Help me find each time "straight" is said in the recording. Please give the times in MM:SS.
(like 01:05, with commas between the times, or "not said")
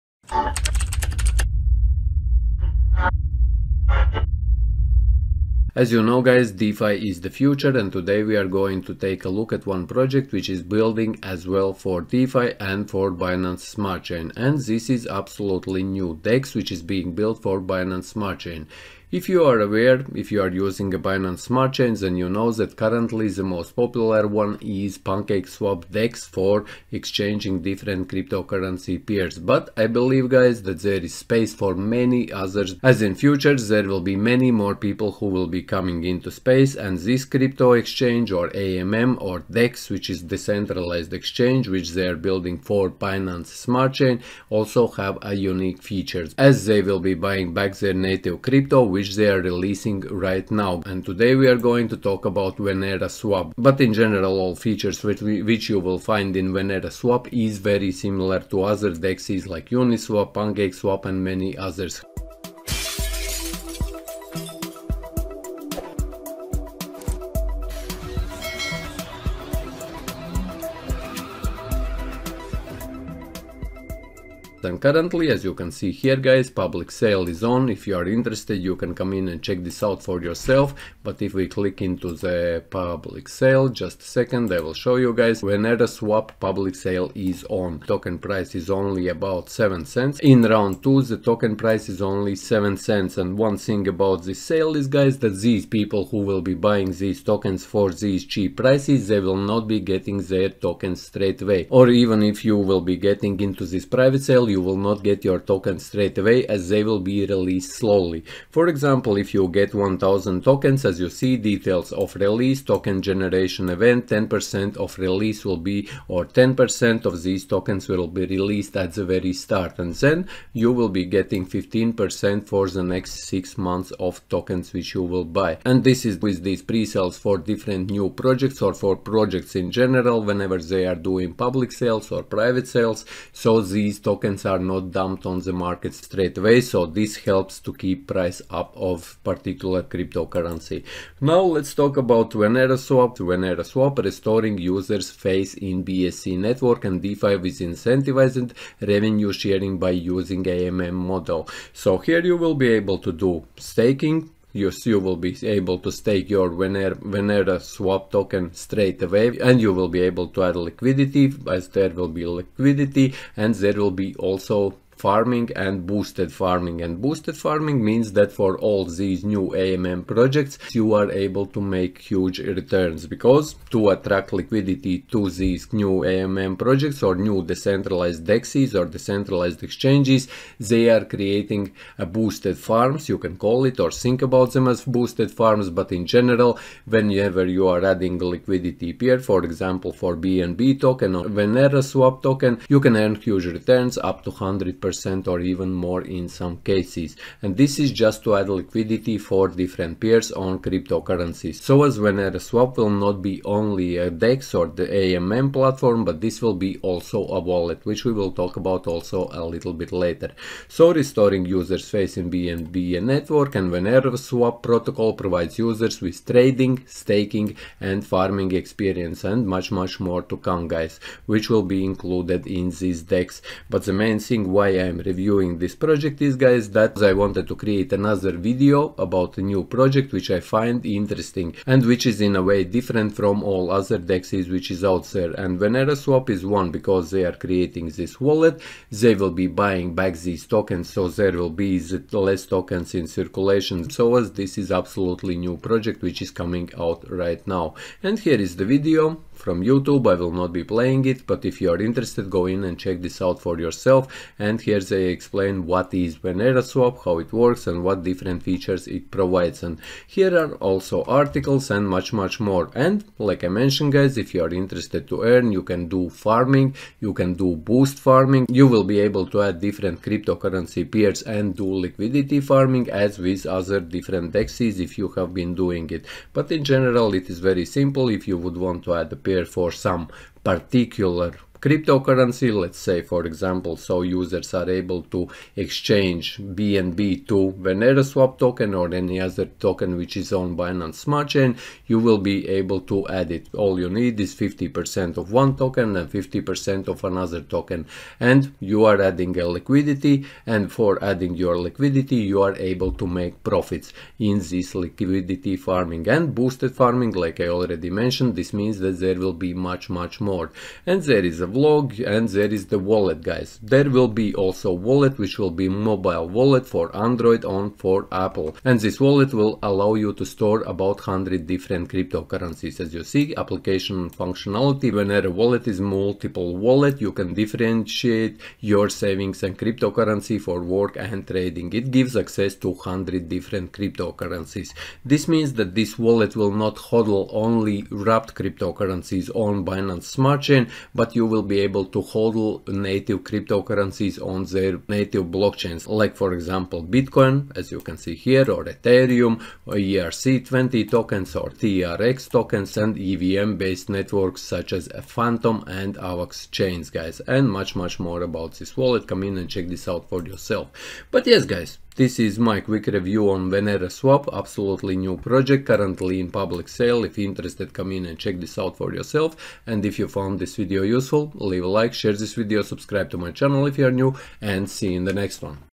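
01:41, 01:45, 02:15, 02:38.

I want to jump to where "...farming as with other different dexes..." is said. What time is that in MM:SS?
04:32.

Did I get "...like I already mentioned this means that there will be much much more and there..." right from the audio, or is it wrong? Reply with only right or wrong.
right.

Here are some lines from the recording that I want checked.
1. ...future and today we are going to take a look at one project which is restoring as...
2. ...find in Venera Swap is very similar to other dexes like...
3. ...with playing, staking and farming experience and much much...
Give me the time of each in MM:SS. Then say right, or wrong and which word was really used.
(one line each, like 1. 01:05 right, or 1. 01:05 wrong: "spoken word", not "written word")
1. 00:07 wrong: "building", not "restoring"
2. 00:55 right
3. 03:36 wrong: "trading", not "playing".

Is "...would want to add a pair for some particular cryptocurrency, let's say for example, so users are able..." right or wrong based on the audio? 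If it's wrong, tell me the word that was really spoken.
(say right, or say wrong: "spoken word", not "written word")
right.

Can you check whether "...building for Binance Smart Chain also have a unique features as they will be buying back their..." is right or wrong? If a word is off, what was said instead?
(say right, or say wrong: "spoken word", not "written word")
right.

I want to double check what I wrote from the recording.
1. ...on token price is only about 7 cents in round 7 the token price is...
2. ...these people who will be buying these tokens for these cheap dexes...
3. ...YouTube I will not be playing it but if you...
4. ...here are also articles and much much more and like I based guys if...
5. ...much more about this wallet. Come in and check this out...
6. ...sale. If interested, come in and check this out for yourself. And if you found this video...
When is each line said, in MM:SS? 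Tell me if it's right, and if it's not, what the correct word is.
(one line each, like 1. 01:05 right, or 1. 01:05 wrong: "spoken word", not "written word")
1. 01:27 wrong: "2", not "7"
2. 01:35 wrong: "prices", not "dexes"
3. 04:09 right
4. 04:20 wrong: "mentioned", not "based"
5. 05:57 right
6. 06:06 right.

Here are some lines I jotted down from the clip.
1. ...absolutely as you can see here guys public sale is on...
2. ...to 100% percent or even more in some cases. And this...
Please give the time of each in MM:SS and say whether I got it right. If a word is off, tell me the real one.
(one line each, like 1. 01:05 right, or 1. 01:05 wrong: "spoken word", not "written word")
1. 01:14 wrong: "currently", not "absolutely"
2. 03:14 right.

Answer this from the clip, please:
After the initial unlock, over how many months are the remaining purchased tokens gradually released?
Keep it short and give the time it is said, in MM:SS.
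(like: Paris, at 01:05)
6 months, at 02:03.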